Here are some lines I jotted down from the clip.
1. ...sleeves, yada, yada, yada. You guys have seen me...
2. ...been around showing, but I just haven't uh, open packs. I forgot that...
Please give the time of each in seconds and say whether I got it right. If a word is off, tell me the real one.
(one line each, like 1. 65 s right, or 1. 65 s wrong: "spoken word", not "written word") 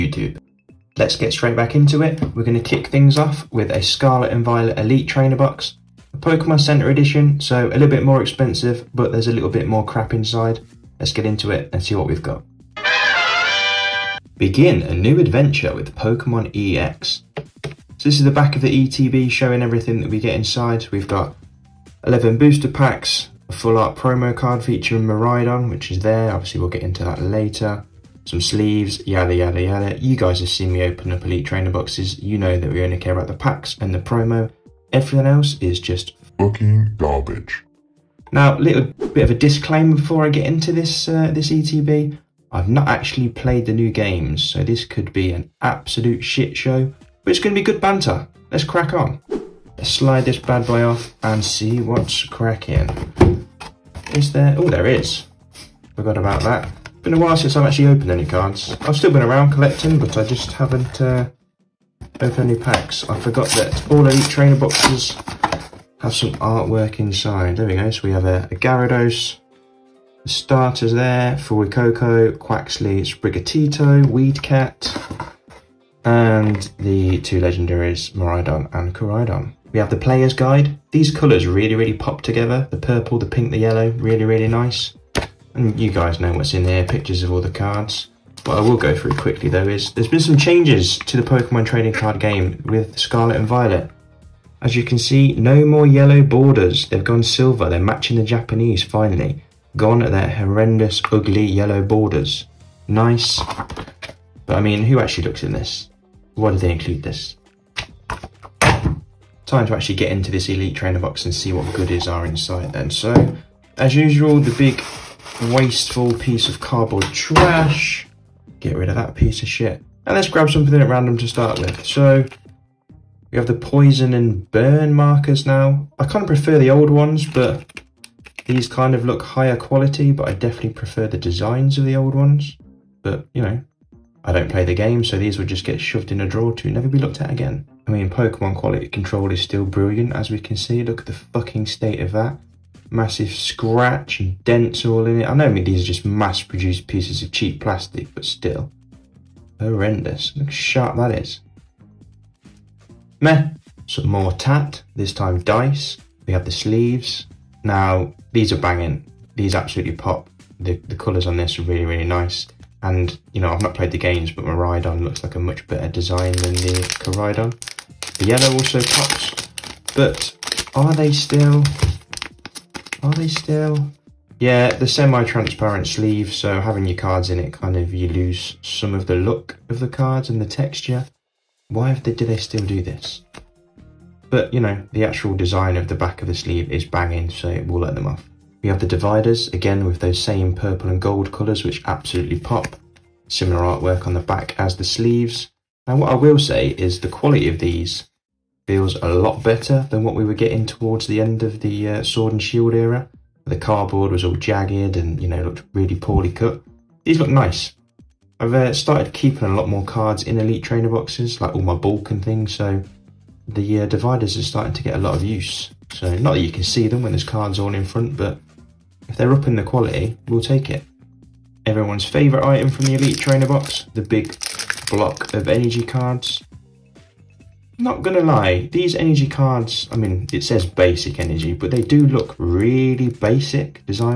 1. 28 s right
2. 59 s wrong: "collecting", not "showing".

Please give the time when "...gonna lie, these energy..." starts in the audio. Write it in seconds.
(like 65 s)
228 s.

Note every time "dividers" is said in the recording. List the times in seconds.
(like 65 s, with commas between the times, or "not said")
188 s, 213 s.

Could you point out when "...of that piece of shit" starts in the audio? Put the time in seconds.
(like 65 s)
118 s.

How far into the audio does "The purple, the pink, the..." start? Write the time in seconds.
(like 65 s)
82 s.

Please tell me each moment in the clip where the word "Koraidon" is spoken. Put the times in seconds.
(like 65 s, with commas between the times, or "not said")
78 s, 166 s.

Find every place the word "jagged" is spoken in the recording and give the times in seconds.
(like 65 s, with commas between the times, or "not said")
204 s.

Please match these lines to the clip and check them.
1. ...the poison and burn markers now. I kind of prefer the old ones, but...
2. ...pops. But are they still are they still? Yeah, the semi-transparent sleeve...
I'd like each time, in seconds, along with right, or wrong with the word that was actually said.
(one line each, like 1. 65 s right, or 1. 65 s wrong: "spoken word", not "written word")
1. 123 s right
2. 168 s right.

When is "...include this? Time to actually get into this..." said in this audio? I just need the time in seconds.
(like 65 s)
106 s.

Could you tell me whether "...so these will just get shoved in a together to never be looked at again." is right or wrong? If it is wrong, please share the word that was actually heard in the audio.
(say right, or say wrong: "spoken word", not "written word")
wrong: "drawer", not "together".